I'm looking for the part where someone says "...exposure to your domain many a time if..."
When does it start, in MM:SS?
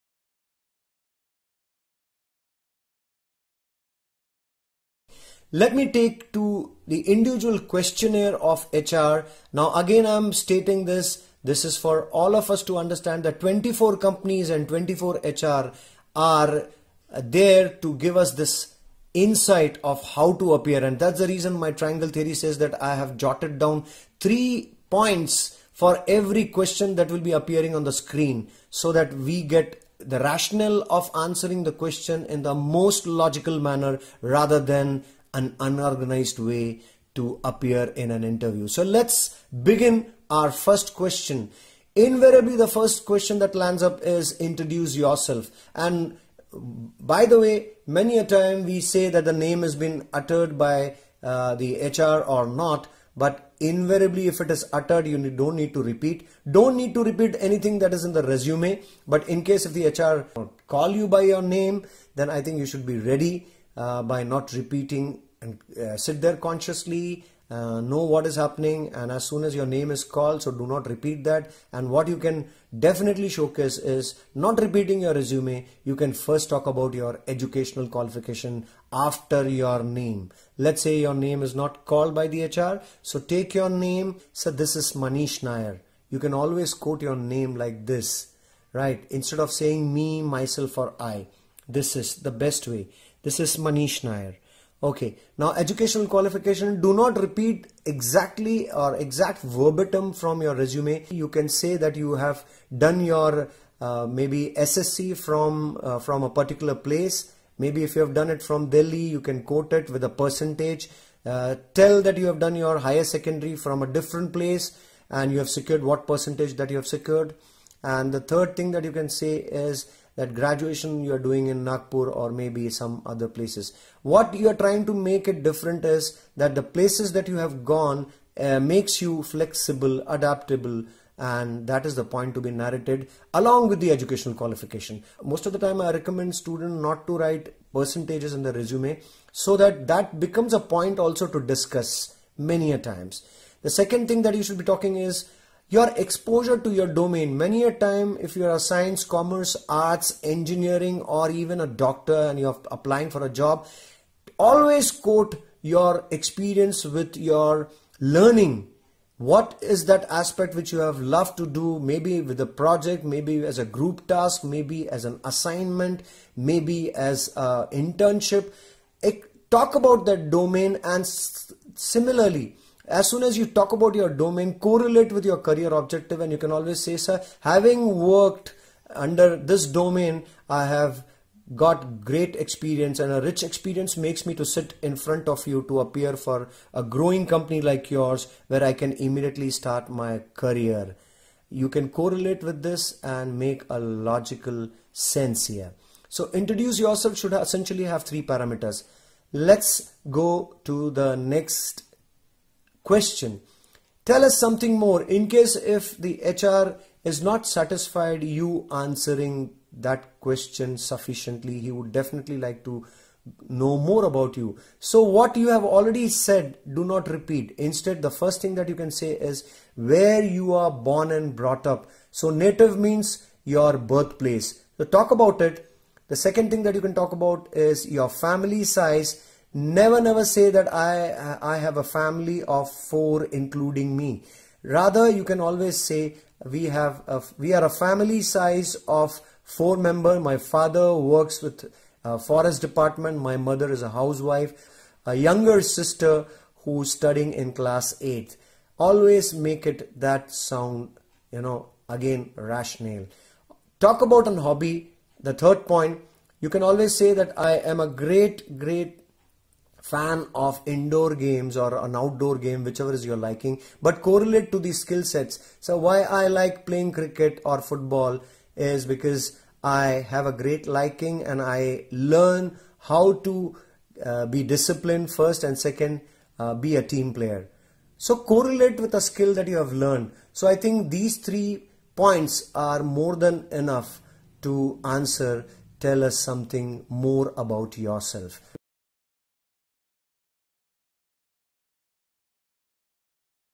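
02:26.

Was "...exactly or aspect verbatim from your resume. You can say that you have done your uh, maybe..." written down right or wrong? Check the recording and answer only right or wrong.
wrong.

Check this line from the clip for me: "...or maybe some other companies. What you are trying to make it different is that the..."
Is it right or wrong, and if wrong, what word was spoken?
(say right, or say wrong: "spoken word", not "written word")
wrong: "places", not "companies".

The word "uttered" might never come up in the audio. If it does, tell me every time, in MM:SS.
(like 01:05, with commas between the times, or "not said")
00:50, 00:54.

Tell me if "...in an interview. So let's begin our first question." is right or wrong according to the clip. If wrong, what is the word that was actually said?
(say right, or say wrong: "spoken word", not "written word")
right.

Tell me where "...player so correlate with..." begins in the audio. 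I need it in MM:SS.
04:37.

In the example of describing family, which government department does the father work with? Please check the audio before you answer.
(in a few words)
Forest department.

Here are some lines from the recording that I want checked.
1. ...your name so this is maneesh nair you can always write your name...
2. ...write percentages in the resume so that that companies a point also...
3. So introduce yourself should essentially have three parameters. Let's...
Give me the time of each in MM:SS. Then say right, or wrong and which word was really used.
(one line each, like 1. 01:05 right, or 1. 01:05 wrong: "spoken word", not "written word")
1. 01:23 wrong: "quote", not "write"
2. 02:17 wrong: "becomes", not "companies"
3. 03:16 right.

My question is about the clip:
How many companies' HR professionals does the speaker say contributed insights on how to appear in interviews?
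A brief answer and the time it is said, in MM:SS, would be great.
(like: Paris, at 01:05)
24, at 00:13.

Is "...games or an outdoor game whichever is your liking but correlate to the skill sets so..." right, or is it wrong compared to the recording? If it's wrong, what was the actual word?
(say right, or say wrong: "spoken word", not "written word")
right.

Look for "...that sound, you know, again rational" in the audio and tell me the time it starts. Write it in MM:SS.
04:09.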